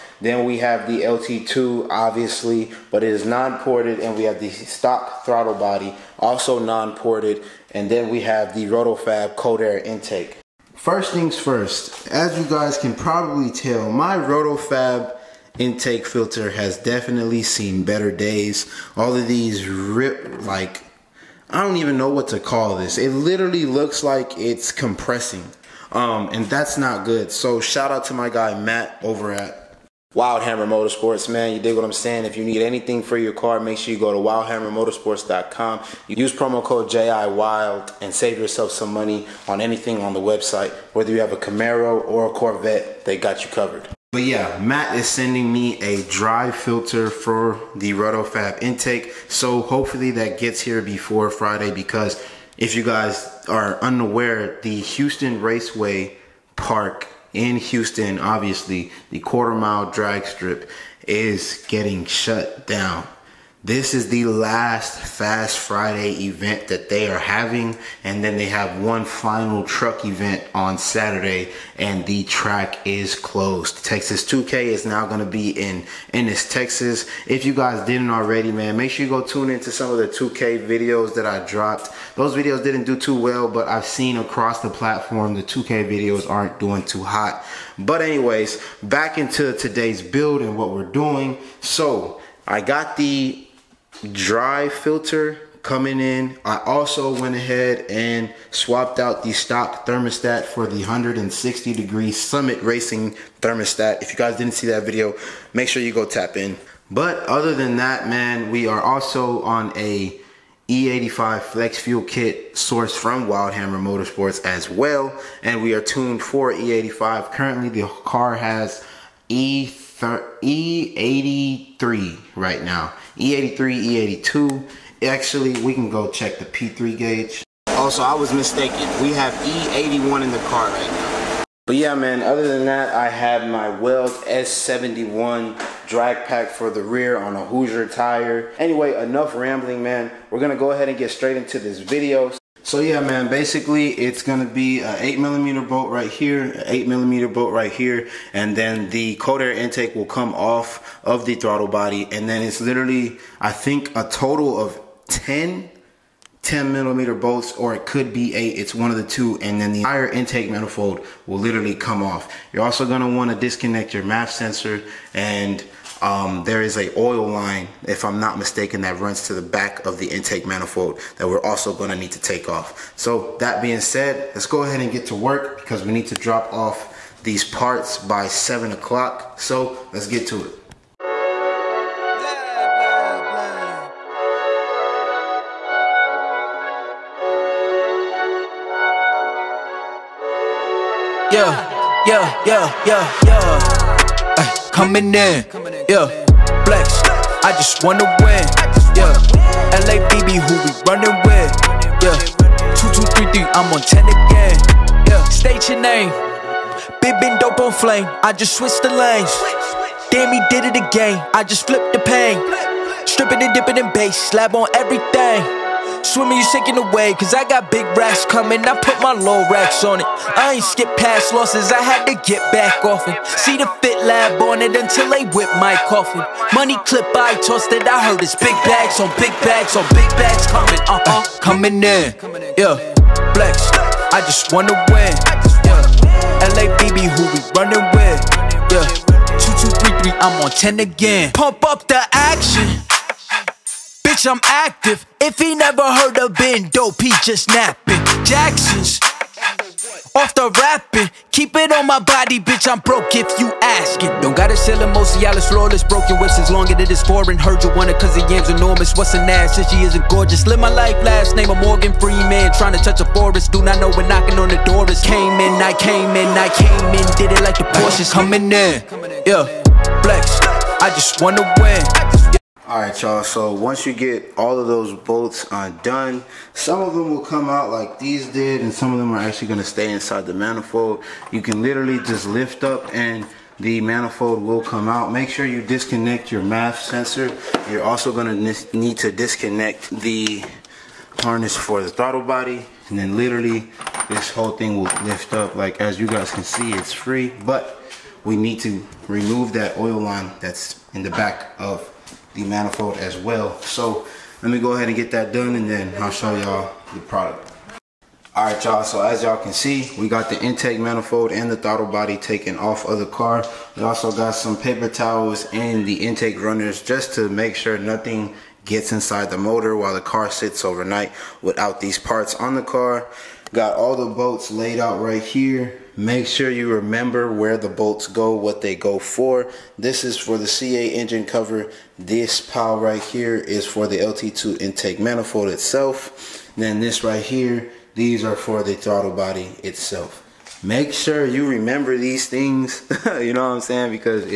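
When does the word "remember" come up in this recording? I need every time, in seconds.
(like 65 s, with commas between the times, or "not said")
326 s, 341 s.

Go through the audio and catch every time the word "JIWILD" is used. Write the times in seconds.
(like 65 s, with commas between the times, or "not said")
36 s.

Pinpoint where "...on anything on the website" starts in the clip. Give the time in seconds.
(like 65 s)
39 s.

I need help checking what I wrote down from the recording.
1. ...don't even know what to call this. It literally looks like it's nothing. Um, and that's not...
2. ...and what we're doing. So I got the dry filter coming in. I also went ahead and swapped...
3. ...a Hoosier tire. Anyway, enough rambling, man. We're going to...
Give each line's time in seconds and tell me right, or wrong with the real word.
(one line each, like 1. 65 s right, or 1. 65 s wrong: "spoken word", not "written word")
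1. 21 s wrong: "compressing", not "nothing"
2. 90 s right
3. 137 s right.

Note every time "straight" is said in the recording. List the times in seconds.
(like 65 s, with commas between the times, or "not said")
141 s.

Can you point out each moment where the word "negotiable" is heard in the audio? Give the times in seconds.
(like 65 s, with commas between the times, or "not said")
not said.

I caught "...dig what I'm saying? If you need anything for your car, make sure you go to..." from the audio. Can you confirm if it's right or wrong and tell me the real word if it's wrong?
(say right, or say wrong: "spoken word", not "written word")
right.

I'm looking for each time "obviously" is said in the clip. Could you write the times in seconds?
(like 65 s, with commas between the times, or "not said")
1 s, 58 s.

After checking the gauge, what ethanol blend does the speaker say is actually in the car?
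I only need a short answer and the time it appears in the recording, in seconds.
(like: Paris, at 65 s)
E81, at 129 s.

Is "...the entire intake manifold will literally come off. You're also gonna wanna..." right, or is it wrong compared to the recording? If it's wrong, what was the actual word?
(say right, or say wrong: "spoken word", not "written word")
right.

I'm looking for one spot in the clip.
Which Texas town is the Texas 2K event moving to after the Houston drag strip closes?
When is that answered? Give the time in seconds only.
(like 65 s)
76 s.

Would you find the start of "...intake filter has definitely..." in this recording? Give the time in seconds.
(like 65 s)
15 s.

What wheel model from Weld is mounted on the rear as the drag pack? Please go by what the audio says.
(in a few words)
S71.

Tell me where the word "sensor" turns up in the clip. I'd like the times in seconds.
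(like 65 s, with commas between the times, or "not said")
164 s, 286 s.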